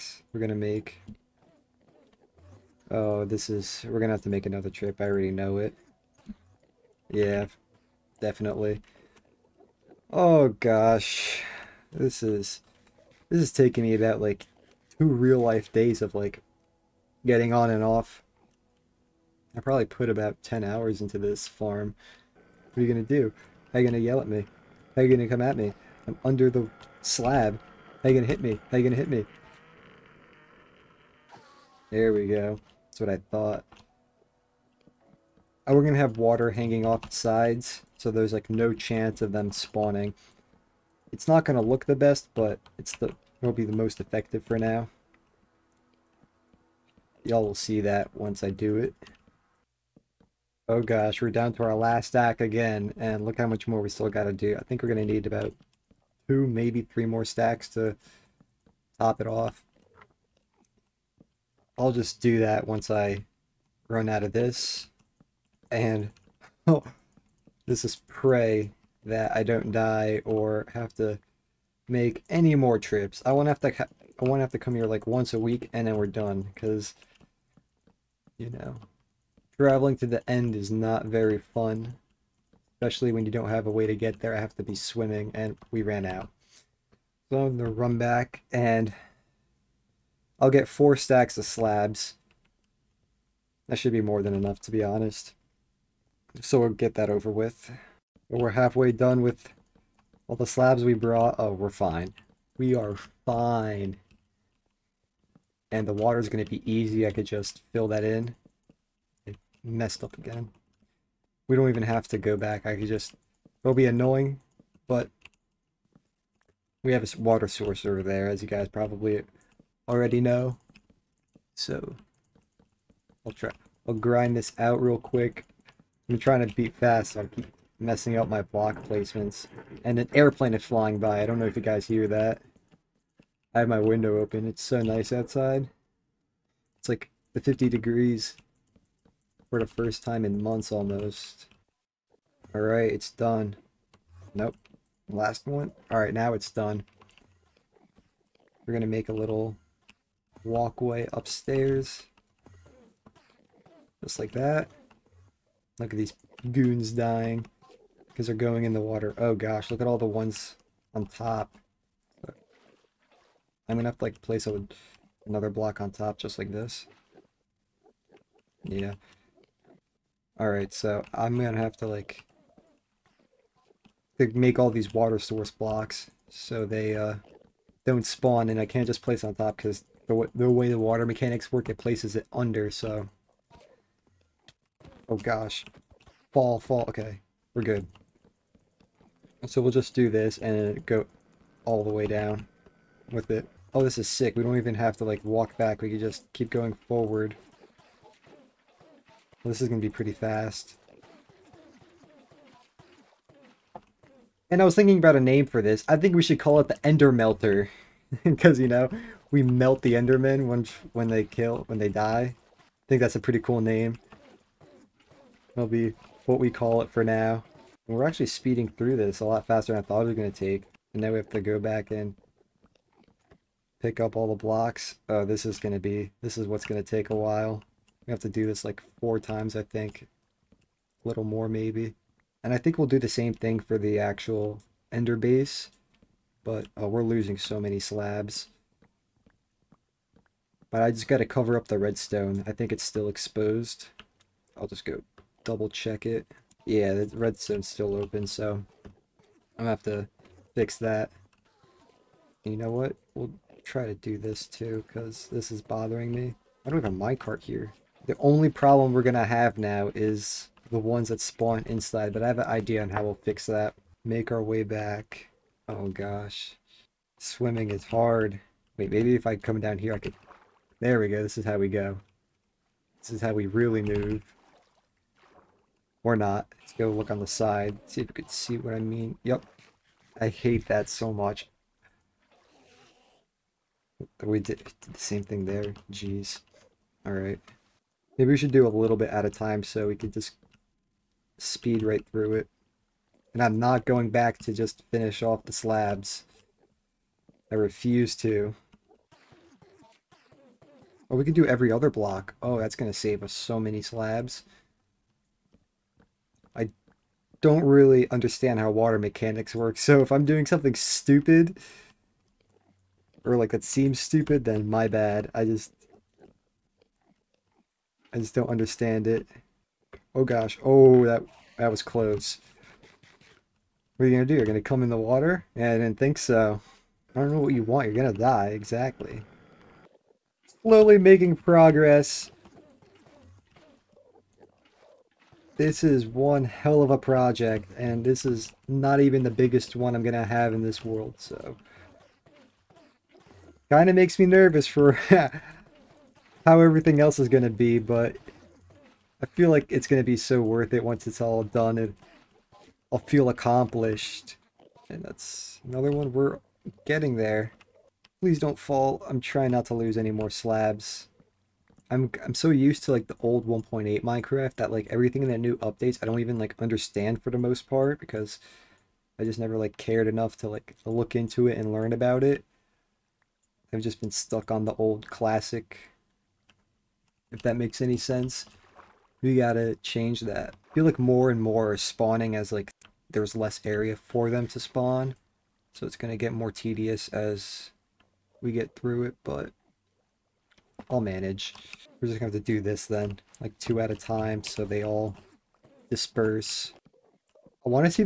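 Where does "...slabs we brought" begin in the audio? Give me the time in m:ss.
1:40.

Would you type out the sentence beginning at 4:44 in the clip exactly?
We did, did the same thing there.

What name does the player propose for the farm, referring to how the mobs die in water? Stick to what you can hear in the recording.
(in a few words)
Ender Melter.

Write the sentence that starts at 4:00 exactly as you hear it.
But I just got to cover up the redstone.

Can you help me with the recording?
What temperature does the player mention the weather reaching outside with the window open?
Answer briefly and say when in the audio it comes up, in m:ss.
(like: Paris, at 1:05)
50 degrees, at 2:17.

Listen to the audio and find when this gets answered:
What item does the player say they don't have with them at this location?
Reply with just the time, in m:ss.
4:17.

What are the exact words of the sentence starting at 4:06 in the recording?
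Yeah, the redstone's still open, so I'm gonna have to fix that.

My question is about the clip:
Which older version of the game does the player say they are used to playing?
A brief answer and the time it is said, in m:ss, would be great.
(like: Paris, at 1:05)
1.8, at 6:03.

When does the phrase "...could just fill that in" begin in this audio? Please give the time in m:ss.
1:47.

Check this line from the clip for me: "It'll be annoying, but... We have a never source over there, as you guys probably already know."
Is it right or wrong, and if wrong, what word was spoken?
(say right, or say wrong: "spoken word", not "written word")
wrong: "water", not "never".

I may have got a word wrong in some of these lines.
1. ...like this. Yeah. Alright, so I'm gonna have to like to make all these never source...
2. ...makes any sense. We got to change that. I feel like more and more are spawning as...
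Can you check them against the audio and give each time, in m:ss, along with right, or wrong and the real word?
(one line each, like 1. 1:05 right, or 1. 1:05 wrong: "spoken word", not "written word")
1. 2:46 wrong: "water", not "never"
2. 6:17 right.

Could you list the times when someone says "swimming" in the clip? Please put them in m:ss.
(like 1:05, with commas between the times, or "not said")
1:24, 4:27.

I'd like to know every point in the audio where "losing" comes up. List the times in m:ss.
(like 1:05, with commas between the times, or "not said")
3:57.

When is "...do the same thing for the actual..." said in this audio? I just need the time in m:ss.
3:52.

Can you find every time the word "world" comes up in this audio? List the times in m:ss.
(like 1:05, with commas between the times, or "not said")
5:40.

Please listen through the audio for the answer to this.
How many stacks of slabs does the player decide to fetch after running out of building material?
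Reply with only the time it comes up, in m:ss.
1:30.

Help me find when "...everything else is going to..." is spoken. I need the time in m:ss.
5:46.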